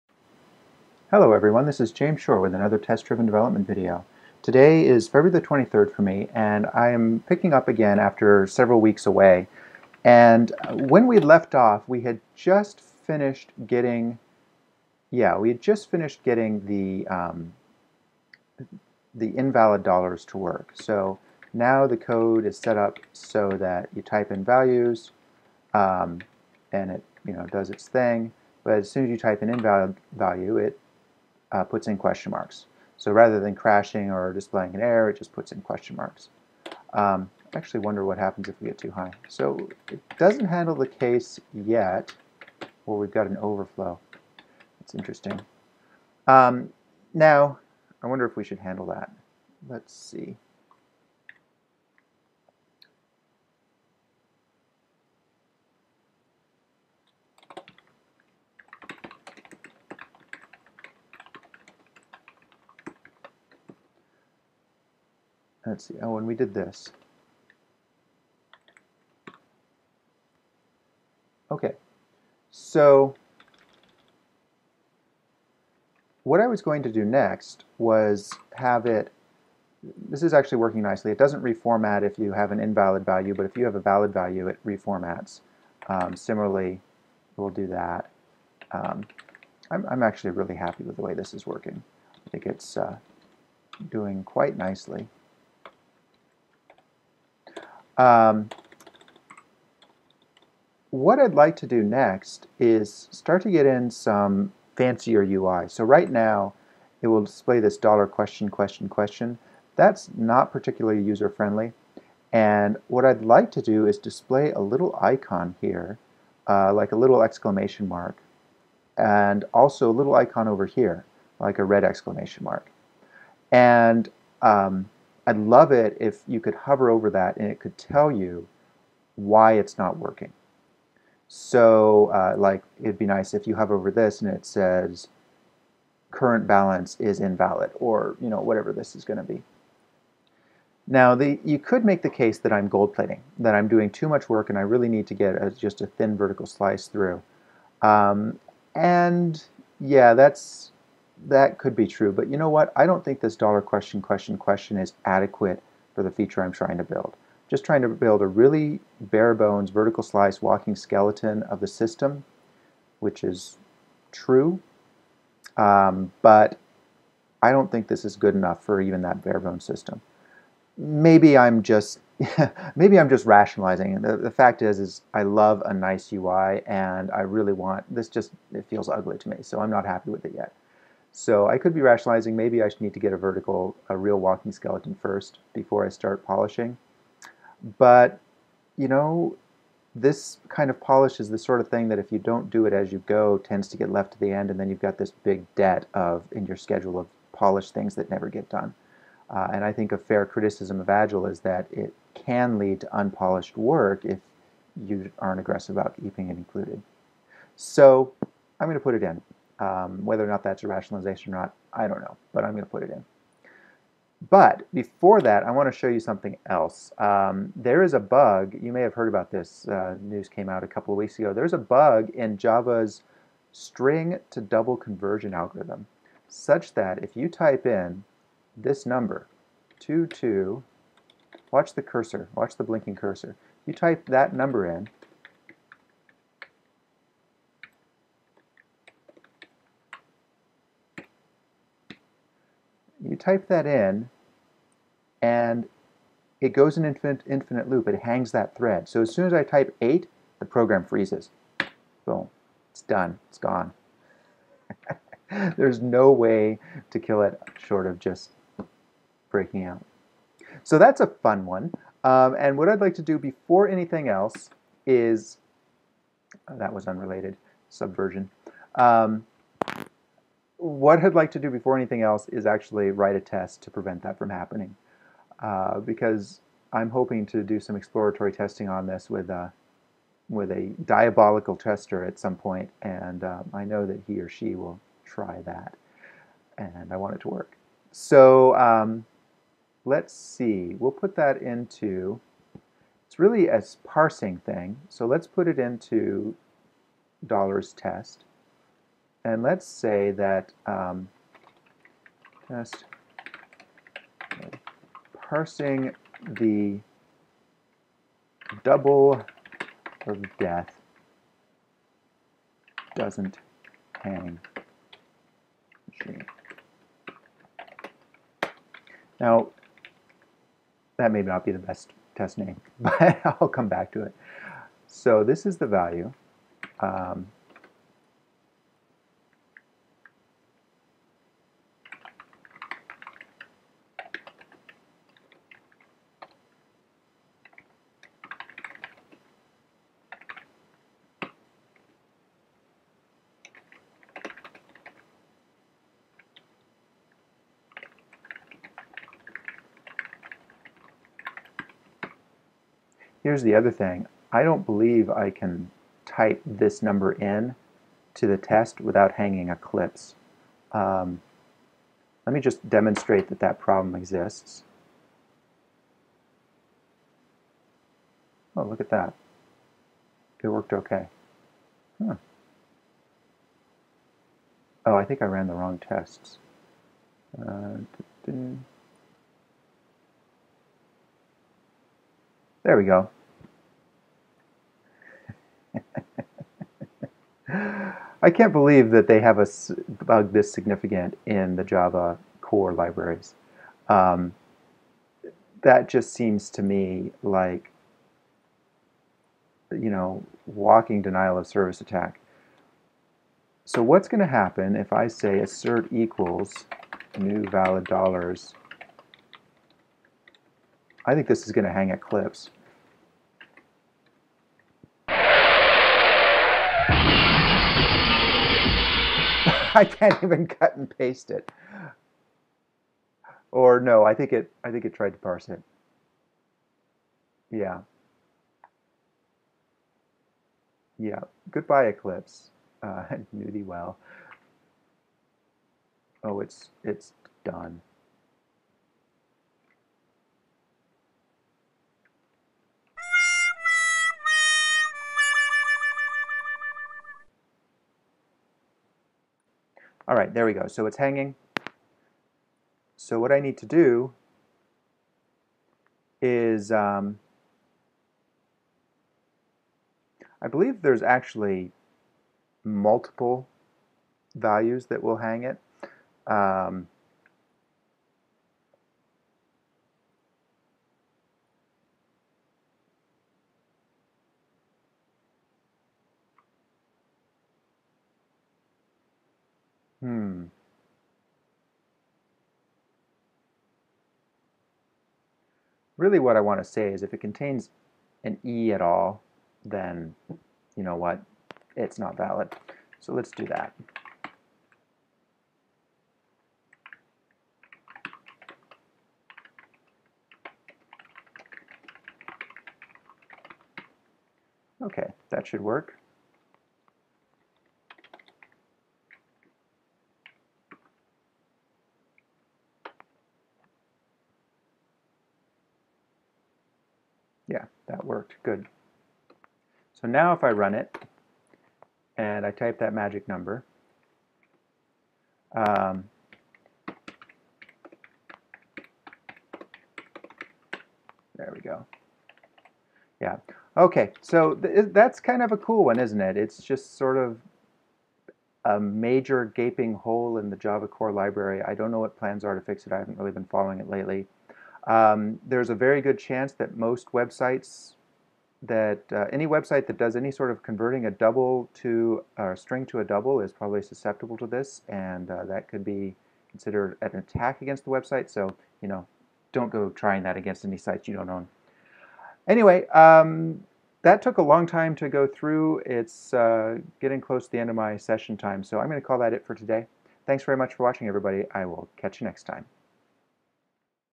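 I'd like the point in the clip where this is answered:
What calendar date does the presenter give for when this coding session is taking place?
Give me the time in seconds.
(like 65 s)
5 s.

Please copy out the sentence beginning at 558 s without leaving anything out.
So you know, don't go trying that against any sites you don't own.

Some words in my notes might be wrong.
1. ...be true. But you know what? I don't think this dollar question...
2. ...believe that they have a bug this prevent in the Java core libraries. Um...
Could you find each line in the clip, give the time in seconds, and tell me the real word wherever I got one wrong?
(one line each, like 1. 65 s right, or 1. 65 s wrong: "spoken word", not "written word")
1. 151 s right
2. 388 s wrong: "significant", not "prevent".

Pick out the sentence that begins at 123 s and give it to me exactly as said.
And um, I'd love it if you could hover over that and it could tell you why it's not working.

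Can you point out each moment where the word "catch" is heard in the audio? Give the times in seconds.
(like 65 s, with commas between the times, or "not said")
571 s.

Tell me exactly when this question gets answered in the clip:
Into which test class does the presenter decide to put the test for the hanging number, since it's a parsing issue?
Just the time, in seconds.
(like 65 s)
297 s.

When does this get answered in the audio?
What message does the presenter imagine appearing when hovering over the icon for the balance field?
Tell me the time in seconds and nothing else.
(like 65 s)
136 s.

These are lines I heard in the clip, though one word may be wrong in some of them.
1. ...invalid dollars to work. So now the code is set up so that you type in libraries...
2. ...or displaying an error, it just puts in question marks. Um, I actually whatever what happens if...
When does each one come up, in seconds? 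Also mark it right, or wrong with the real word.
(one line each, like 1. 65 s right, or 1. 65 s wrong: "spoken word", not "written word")
1. 19 s wrong: "values", not "libraries"
2. 34 s wrong: "wonder", not "whatever".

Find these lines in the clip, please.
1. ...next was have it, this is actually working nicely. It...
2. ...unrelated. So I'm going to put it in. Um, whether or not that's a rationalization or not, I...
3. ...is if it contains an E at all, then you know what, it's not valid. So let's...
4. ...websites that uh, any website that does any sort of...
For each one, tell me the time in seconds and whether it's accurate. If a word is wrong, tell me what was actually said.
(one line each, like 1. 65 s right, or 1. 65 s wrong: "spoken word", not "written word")
1. 77 s right
2. 206 s wrong: "included", not "unrelated"
3. 486 s right
4. 547 s right.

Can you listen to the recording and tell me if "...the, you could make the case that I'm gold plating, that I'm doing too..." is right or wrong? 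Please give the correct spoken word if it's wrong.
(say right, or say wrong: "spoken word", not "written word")
right.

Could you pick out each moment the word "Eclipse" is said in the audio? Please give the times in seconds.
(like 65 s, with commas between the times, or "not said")
359 s, 411 s, 431 s.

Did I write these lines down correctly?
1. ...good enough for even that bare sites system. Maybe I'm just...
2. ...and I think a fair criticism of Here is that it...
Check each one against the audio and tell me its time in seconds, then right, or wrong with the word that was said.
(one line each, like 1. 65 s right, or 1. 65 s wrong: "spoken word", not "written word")
1. 168 s wrong: "bones", not "sites"
2. 199 s wrong: "Agile", not "Here".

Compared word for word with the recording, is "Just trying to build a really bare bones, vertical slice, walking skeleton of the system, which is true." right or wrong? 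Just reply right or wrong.
right.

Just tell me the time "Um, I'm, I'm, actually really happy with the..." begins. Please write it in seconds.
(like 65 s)
88 s.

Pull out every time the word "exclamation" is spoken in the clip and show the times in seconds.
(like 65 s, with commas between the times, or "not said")
117 s, 121 s.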